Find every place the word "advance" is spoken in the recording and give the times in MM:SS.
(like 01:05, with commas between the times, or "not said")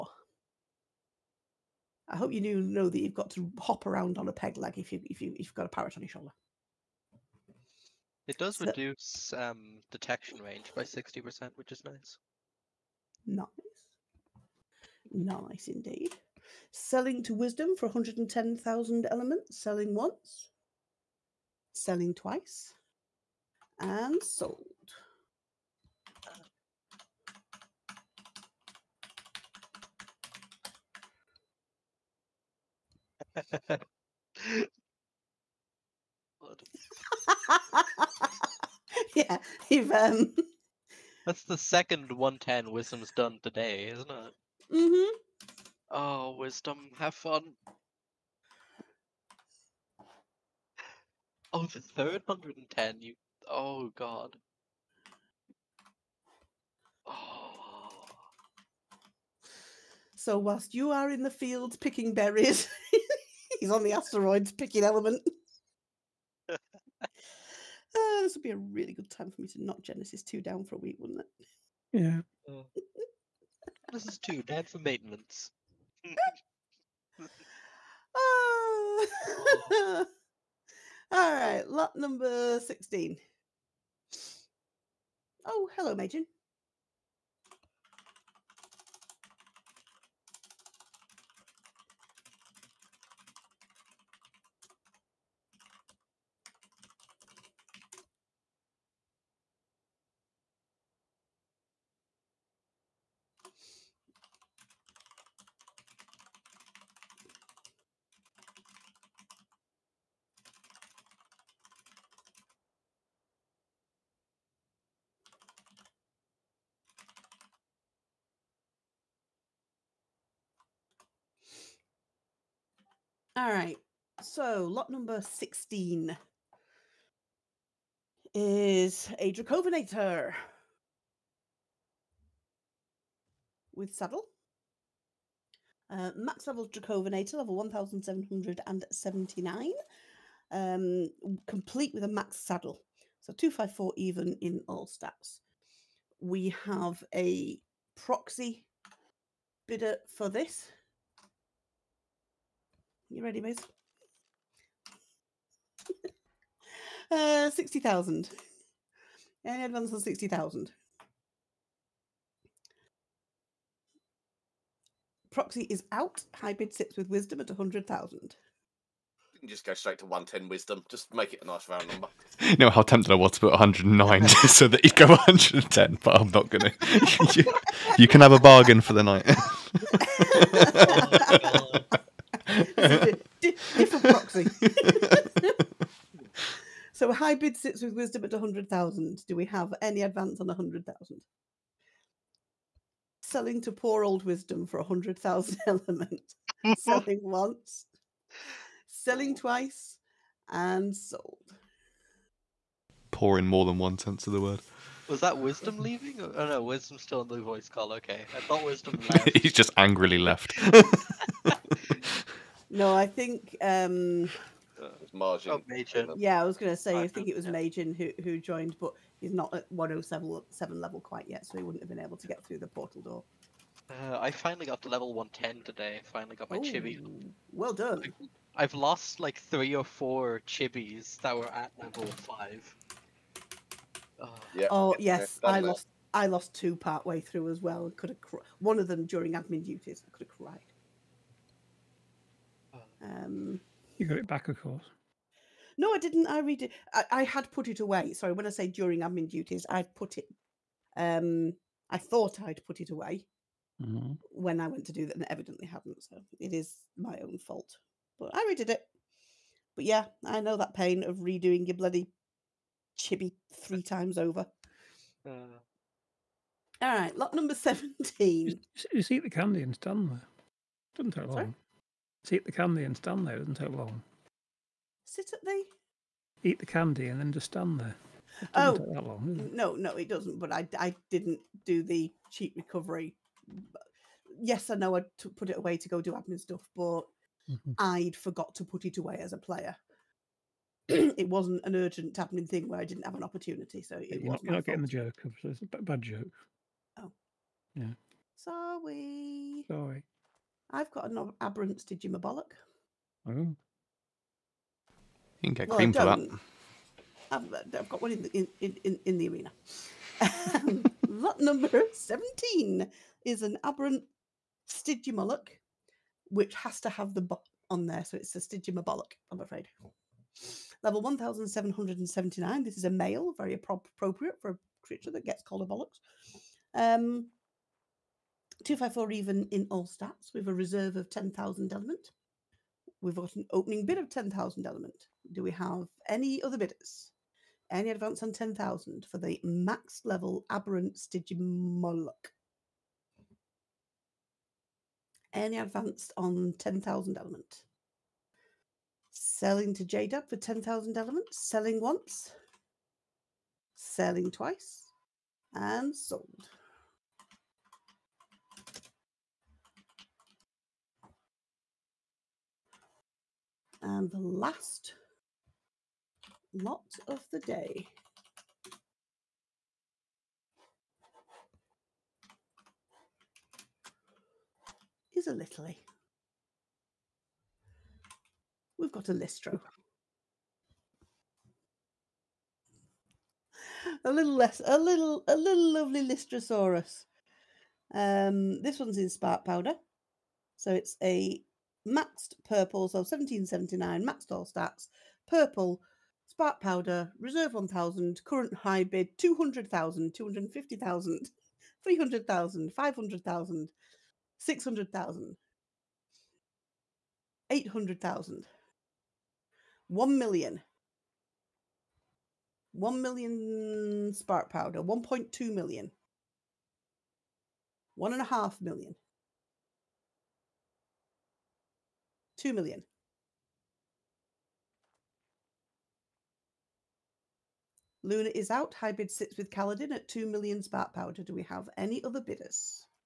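02:39, 03:10, 05:37, 05:45.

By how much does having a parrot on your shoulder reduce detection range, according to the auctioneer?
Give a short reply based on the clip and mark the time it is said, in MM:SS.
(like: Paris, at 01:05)
60%, at 00:10.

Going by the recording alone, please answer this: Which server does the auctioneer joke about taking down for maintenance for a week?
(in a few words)
Genesis 2.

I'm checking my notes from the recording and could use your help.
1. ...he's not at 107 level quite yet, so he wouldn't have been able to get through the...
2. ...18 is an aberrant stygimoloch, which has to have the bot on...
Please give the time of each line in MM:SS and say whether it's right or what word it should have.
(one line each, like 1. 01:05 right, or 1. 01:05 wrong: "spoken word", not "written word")
1. 03:39 right
2. 05:11 wrong: "17", not "18".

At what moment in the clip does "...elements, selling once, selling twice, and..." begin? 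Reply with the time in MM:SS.
00:19.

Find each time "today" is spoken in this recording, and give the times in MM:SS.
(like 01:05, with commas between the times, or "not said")
00:43, 03:45.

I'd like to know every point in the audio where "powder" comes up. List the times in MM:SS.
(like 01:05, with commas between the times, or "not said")
06:29, 07:10.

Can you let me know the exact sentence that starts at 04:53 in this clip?
So it you're, not, you're not getting the joke.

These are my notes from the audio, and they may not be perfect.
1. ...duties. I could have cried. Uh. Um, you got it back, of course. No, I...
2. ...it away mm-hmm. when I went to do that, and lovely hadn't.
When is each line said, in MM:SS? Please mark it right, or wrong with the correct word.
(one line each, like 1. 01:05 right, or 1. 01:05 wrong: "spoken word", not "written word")
1. 03:59 right
2. 04:12 wrong: "evidently", not "lovely".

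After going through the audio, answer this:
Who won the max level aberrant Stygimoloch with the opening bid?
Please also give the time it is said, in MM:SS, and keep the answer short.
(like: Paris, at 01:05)
JDub, at 05:49.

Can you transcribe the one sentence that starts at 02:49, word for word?
You can just go straight to 110 wisdom.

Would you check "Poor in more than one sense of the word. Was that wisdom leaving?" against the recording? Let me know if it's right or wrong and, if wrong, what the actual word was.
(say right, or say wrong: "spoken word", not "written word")
right.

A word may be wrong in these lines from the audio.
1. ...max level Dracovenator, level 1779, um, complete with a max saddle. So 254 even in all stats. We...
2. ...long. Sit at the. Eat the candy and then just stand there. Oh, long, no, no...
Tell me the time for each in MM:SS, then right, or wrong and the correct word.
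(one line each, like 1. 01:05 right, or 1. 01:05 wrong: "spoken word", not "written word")
1. 02:16 right
2. 04:33 right.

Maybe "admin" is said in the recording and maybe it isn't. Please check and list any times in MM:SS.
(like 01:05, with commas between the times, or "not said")
03:59, 04:08, 04:46.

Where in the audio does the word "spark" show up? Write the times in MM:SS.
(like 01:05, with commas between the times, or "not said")
06:29, 07:10.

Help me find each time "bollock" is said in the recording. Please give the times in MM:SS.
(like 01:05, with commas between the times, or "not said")
05:02, 05:25.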